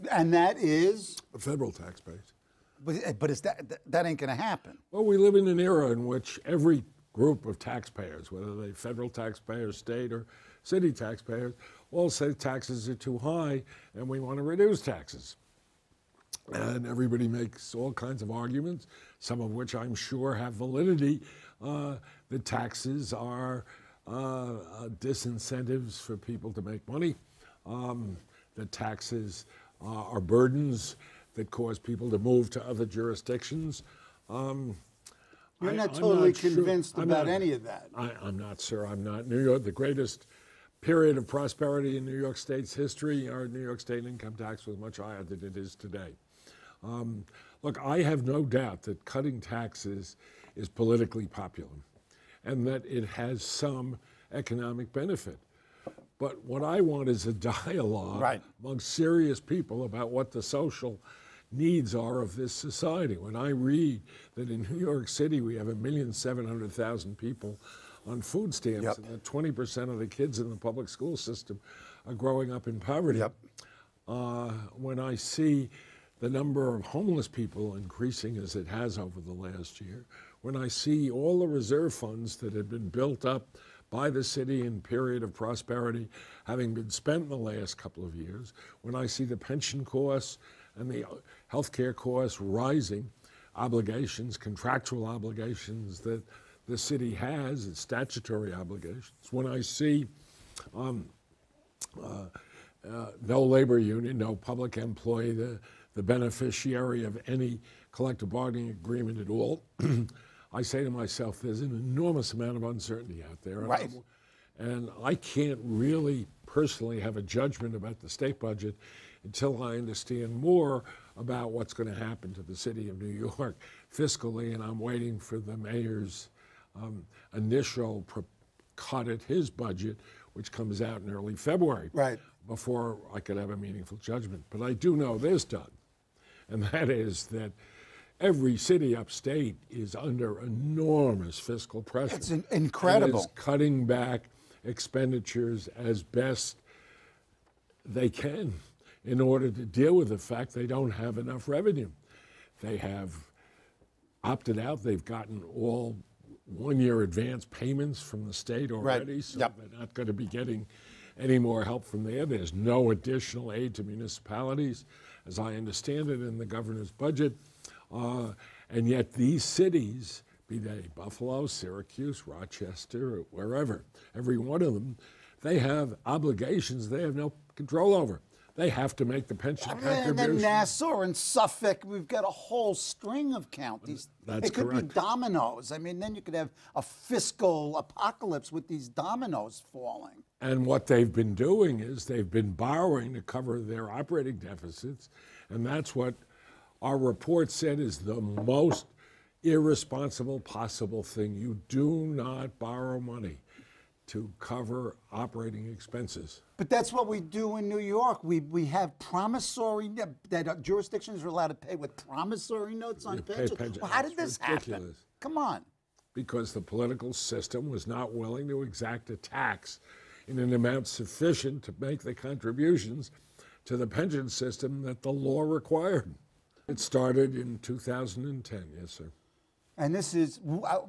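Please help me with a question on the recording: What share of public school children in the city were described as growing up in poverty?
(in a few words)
20%.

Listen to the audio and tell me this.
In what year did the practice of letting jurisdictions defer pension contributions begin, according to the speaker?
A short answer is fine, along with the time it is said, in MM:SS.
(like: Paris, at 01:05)
2010, at 03:47.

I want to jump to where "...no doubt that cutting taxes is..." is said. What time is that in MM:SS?
00:48.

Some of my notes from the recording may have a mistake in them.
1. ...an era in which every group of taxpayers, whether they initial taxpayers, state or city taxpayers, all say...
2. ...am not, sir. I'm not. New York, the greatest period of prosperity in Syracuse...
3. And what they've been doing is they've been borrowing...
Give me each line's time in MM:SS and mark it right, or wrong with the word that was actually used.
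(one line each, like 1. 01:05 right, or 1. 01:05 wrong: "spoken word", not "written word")
1. 00:05 wrong: "federal", not "initial"
2. 00:38 wrong: "New", not "Syracuse"
3. 03:10 right.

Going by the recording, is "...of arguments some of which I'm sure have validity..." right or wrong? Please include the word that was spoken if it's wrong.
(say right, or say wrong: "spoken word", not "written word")
right.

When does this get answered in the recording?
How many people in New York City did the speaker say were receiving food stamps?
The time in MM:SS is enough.
01:05.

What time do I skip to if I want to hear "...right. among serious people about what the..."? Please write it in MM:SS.
00:58.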